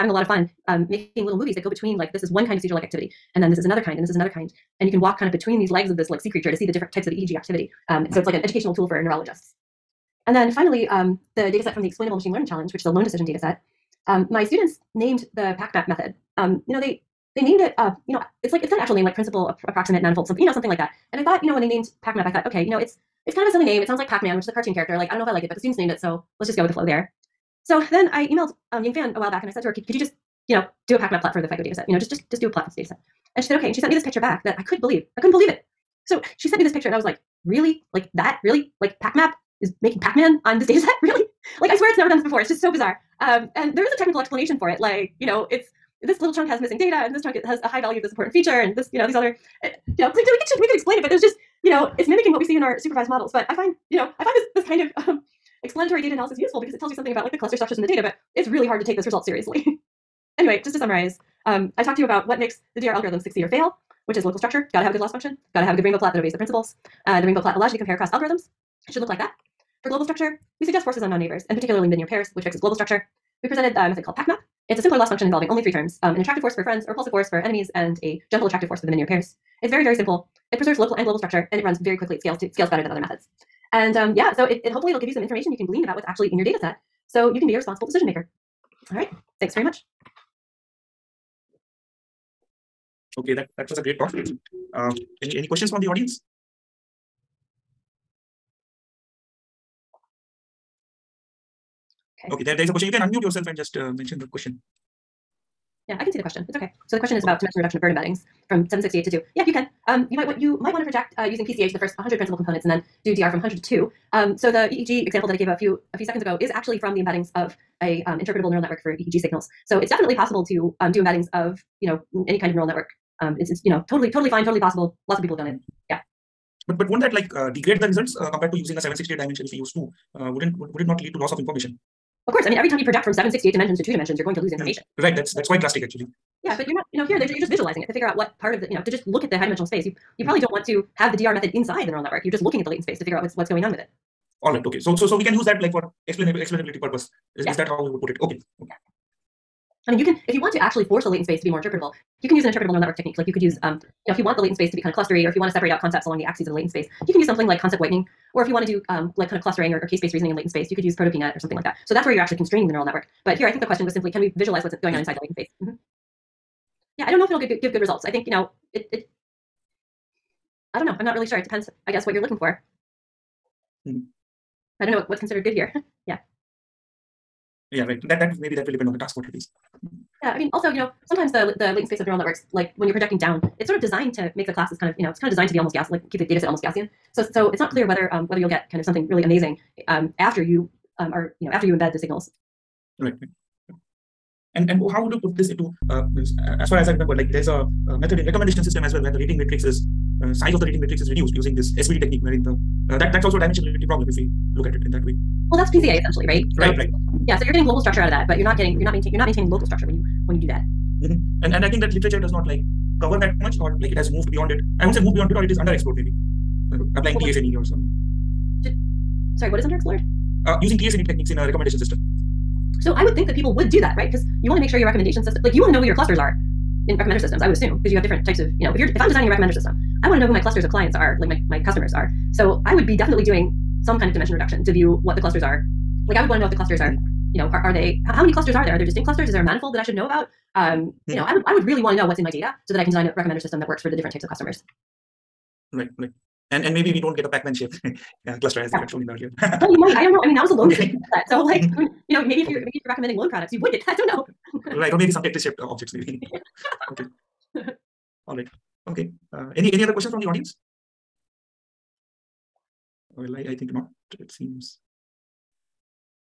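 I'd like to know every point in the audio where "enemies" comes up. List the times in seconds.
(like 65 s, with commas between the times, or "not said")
77 s.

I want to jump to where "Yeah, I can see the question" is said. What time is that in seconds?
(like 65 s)
105 s.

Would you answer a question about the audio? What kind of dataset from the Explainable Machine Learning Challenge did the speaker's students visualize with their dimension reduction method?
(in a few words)
Loan decision.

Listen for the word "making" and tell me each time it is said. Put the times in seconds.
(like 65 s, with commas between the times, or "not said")
0 s, 39 s.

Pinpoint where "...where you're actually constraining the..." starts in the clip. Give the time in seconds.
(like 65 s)
162 s.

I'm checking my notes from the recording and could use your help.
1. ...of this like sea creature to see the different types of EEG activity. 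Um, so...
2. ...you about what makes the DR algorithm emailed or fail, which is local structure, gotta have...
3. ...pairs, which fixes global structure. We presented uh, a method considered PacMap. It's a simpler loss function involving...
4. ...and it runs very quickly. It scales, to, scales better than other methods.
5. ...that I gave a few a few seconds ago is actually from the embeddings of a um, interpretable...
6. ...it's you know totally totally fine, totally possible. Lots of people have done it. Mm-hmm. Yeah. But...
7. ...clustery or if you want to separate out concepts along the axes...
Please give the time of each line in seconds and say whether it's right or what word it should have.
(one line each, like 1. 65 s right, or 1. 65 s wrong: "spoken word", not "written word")
1. 5 s right
2. 61 s wrong: "succeed", not "emailed"
3. 72 s wrong: "called", not "considered"
4. 81 s right
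5. 115 s right
6. 123 s right
7. 154 s right.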